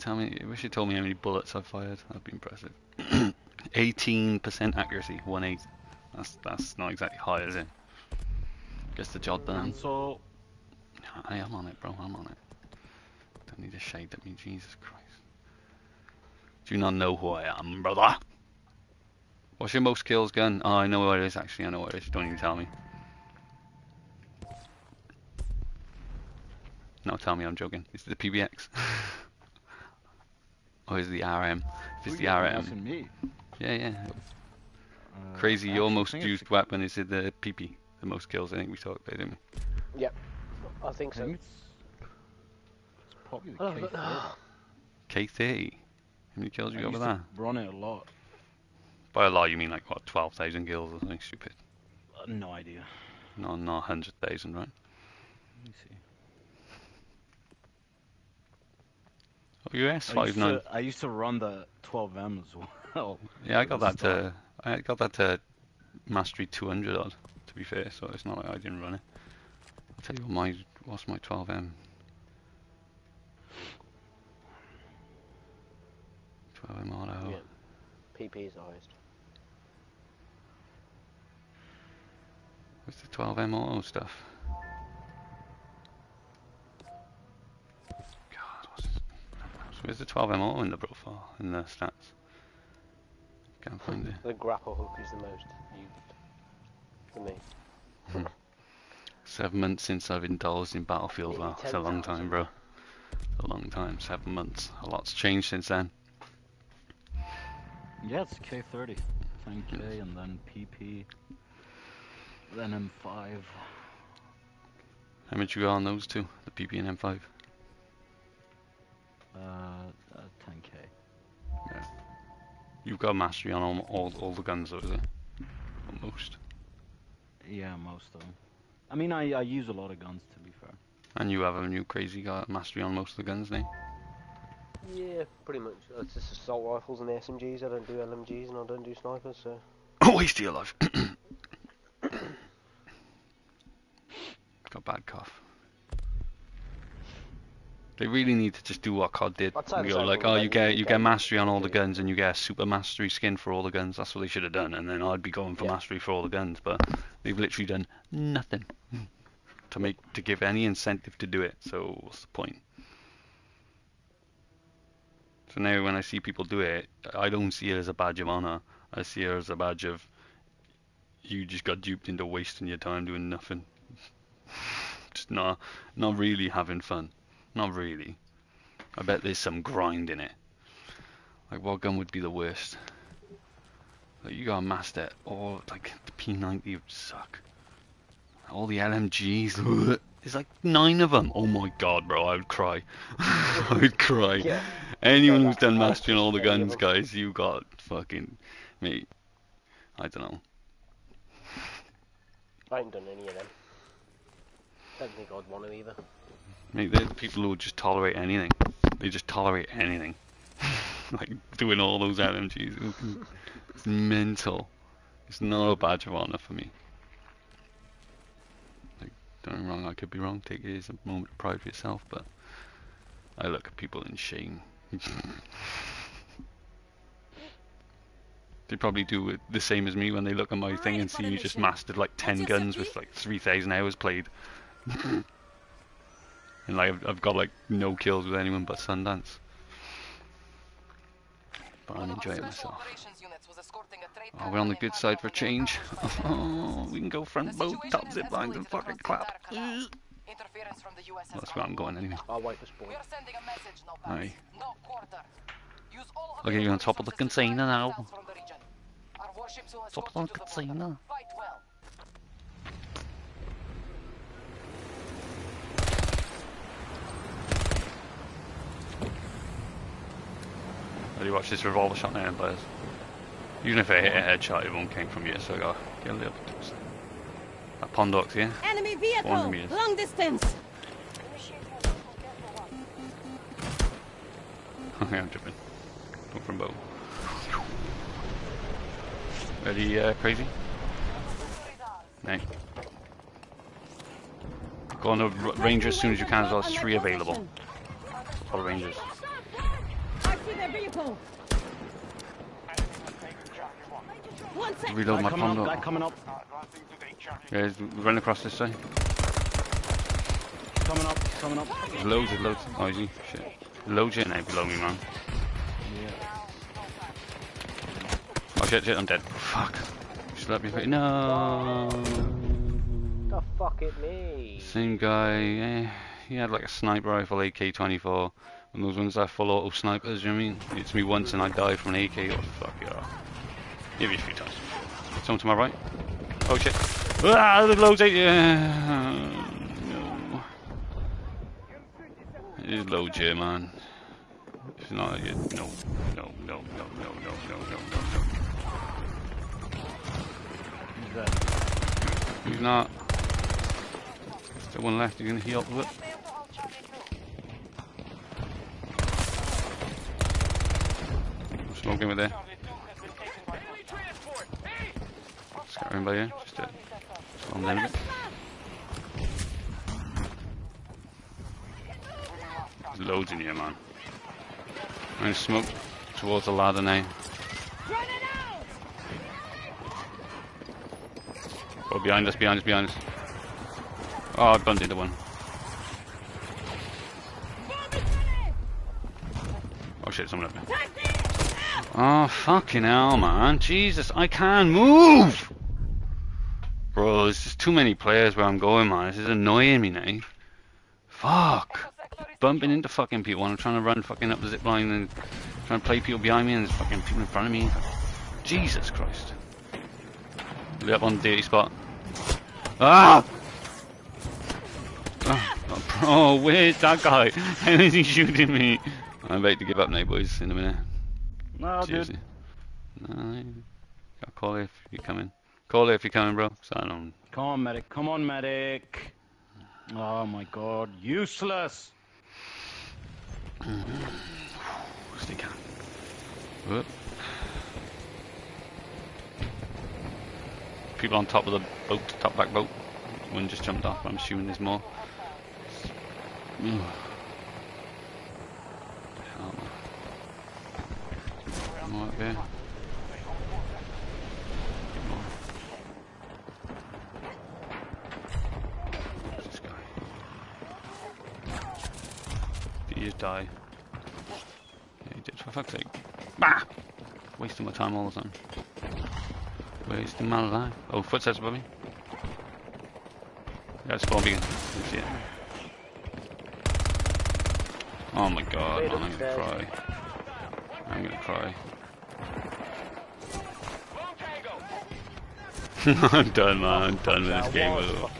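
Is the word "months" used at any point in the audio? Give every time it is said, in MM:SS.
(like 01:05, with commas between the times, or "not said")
01:39, 01:44.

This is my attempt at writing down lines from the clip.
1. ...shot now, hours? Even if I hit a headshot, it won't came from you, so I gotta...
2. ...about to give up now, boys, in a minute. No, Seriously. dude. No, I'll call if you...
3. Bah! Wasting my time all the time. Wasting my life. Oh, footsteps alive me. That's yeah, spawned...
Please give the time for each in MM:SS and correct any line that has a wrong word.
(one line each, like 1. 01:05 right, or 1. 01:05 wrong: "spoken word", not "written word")
1. 04:31 wrong: "players", not "hours"
2. 06:59 right
3. 07:46 wrong: "above", not "alive".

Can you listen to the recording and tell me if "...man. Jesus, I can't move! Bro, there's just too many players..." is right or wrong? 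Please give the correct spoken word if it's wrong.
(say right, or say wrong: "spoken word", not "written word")
right.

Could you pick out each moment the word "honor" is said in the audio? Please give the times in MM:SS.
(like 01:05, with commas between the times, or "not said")
02:48, 03:36.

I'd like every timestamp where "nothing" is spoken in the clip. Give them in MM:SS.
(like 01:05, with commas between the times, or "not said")
02:38, 02:53.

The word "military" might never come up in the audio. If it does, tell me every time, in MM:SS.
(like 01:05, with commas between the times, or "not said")
not said.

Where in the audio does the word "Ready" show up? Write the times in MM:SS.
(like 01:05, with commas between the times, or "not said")
04:49.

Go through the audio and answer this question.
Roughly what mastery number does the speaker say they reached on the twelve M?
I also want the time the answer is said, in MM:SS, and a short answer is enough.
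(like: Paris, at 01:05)
200, at 01:06.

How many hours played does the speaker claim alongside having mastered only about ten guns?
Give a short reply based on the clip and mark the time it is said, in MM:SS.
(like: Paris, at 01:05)
3,000, at 03:53.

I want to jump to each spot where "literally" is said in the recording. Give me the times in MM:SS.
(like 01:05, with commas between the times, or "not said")
02:37.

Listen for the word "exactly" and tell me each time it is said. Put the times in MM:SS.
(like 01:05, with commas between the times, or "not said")
00:06.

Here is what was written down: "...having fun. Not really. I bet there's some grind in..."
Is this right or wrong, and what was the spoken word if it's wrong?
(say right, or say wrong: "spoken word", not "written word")
right.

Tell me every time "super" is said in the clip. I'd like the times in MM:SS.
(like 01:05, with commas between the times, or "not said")
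02:32.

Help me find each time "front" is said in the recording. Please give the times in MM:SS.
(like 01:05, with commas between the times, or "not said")
04:07, 06:47.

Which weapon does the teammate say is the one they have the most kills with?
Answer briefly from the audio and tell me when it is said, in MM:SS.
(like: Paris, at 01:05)
K30, at 01:48.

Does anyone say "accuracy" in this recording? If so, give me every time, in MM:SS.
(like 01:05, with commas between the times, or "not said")
00:04.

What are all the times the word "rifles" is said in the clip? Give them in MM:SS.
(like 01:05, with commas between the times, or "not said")
02:16, 05:27.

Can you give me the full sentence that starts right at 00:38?
The most kills, I think we talked about, didn't we?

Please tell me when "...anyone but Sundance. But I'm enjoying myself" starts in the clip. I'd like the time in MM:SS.
03:58.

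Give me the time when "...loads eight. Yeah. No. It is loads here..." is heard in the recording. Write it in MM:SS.
05:37.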